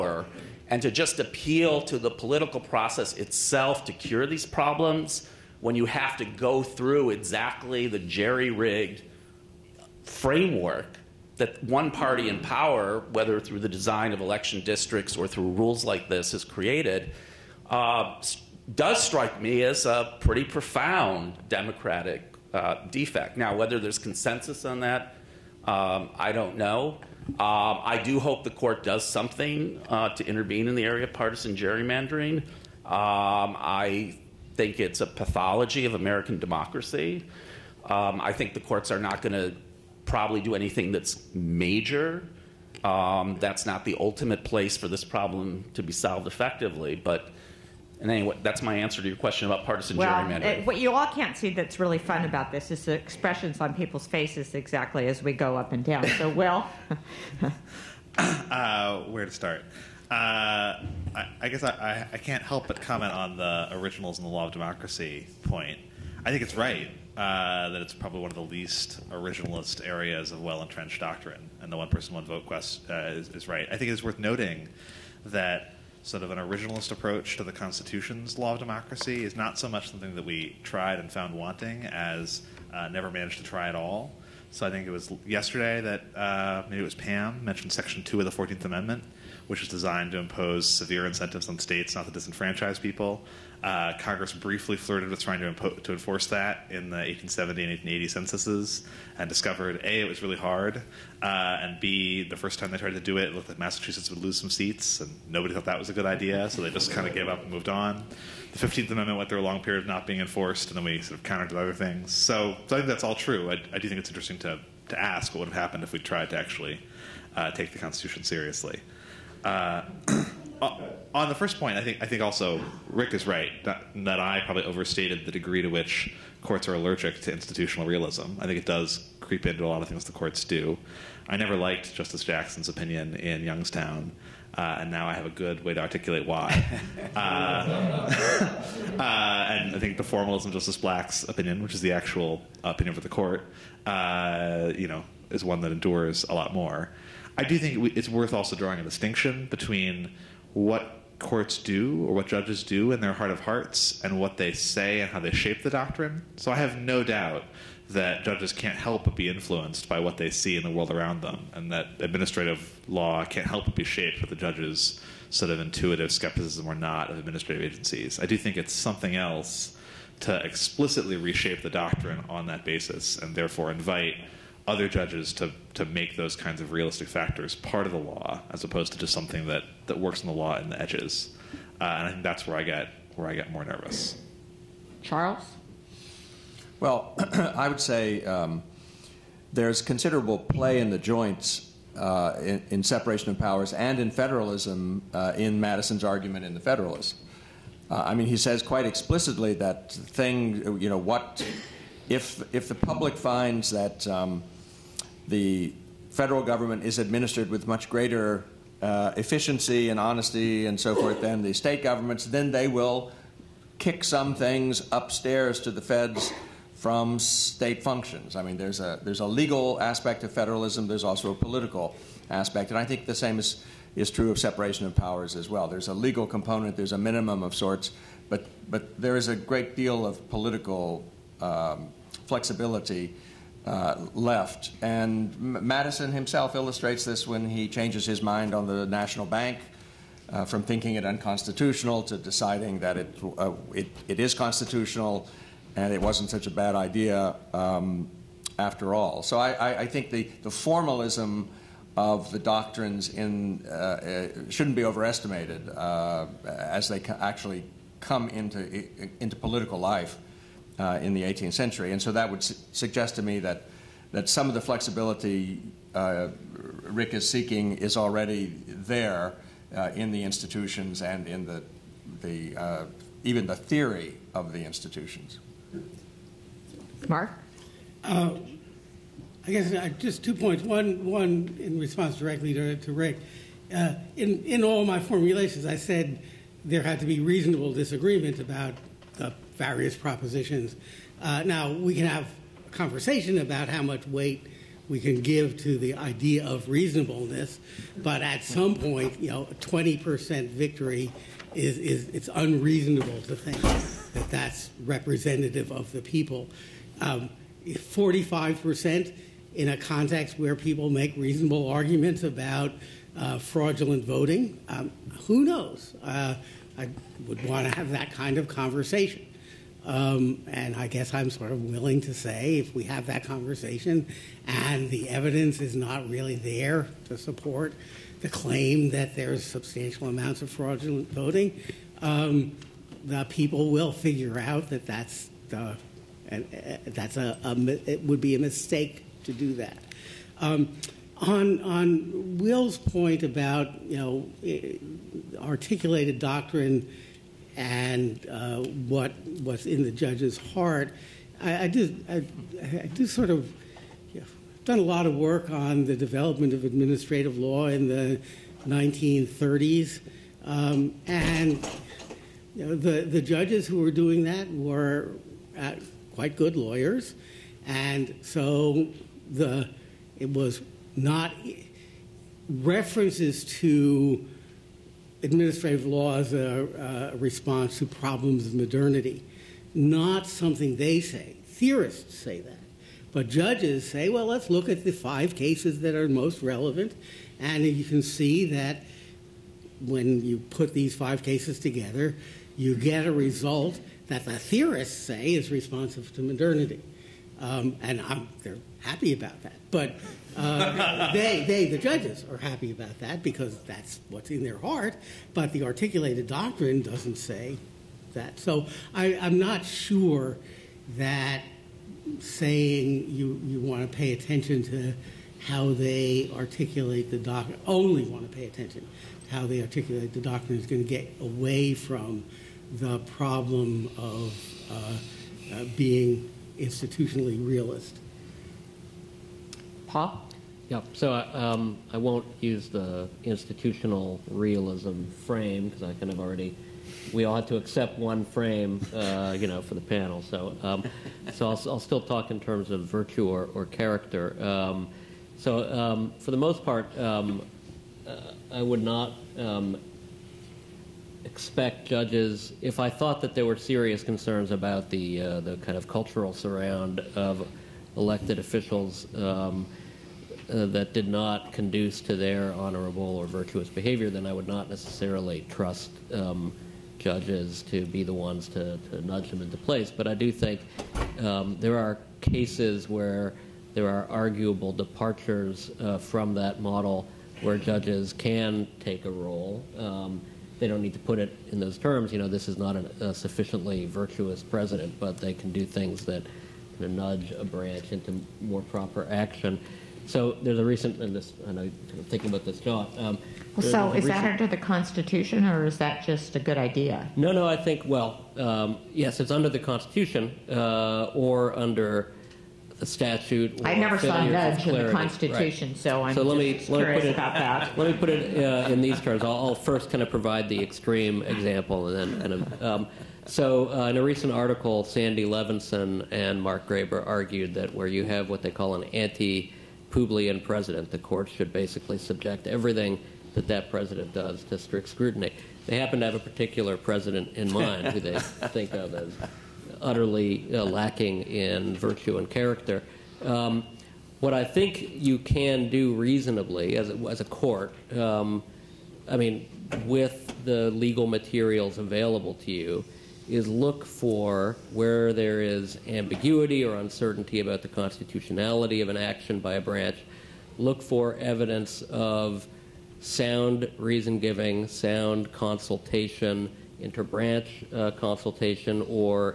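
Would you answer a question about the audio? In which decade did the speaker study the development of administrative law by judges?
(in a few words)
1930s.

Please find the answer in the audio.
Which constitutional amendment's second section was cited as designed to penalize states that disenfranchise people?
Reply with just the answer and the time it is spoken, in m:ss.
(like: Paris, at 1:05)
14th Amendment, at 1:28.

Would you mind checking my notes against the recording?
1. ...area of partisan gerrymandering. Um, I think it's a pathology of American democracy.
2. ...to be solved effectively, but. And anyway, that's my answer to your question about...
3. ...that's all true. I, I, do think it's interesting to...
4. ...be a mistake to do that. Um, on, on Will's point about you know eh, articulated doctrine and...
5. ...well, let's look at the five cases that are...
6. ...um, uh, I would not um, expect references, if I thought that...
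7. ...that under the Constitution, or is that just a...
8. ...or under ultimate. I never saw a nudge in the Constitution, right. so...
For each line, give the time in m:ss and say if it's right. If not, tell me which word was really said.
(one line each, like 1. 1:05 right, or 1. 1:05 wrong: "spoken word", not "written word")
1. 0:30 right
2. 0:45 right
3. 1:52 right
4. 5:38 right
5. 6:24 right
6. 7:26 wrong: "judges", not "references"
7. 8:14 right
8. 8:21 wrong: "statute", not "ultimate".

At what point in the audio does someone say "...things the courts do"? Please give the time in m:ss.
2:09.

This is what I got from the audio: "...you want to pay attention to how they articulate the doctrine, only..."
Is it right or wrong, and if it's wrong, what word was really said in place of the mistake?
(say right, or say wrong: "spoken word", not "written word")
right.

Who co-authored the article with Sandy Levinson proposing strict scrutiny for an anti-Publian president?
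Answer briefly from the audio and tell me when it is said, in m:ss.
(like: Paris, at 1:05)
Mark Graber, at 8:36.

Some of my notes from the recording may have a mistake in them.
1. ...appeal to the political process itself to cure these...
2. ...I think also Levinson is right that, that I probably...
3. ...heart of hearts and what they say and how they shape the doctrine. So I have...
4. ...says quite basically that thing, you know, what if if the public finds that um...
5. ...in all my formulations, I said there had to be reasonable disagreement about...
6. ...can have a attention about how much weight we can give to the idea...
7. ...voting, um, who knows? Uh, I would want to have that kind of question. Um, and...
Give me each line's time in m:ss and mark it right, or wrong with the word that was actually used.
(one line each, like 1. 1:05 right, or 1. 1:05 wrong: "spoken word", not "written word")
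1. 0:01 right
2. 2:02 wrong: "Rick", not "Levinson"
3. 2:33 right
4. 3:18 wrong: "explicitly", not "basically"
5. 4:44 right
6. 4:51 wrong: "conversation", not "attention"
7. 5:14 wrong: "conversation", not "question".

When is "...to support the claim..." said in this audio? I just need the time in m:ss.
5:27.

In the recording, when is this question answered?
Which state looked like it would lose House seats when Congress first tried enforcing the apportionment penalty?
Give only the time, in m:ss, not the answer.
1:43.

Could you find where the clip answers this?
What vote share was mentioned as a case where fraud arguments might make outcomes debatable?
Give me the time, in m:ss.
5:07.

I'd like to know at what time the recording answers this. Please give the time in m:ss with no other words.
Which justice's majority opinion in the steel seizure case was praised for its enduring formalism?
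2:20.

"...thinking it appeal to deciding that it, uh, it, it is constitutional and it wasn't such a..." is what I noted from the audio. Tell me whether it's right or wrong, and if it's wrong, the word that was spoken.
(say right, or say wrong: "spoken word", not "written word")
wrong: "unconstitutional", not "appeal".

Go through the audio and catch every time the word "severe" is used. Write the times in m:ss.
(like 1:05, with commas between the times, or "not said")
1:30.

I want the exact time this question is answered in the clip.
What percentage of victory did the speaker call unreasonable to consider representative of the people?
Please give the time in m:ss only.
4:59.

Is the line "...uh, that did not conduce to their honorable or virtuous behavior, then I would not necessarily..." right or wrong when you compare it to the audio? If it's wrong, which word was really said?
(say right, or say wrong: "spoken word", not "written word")
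right.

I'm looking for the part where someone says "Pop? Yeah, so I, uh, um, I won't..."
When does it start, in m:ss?
7:09.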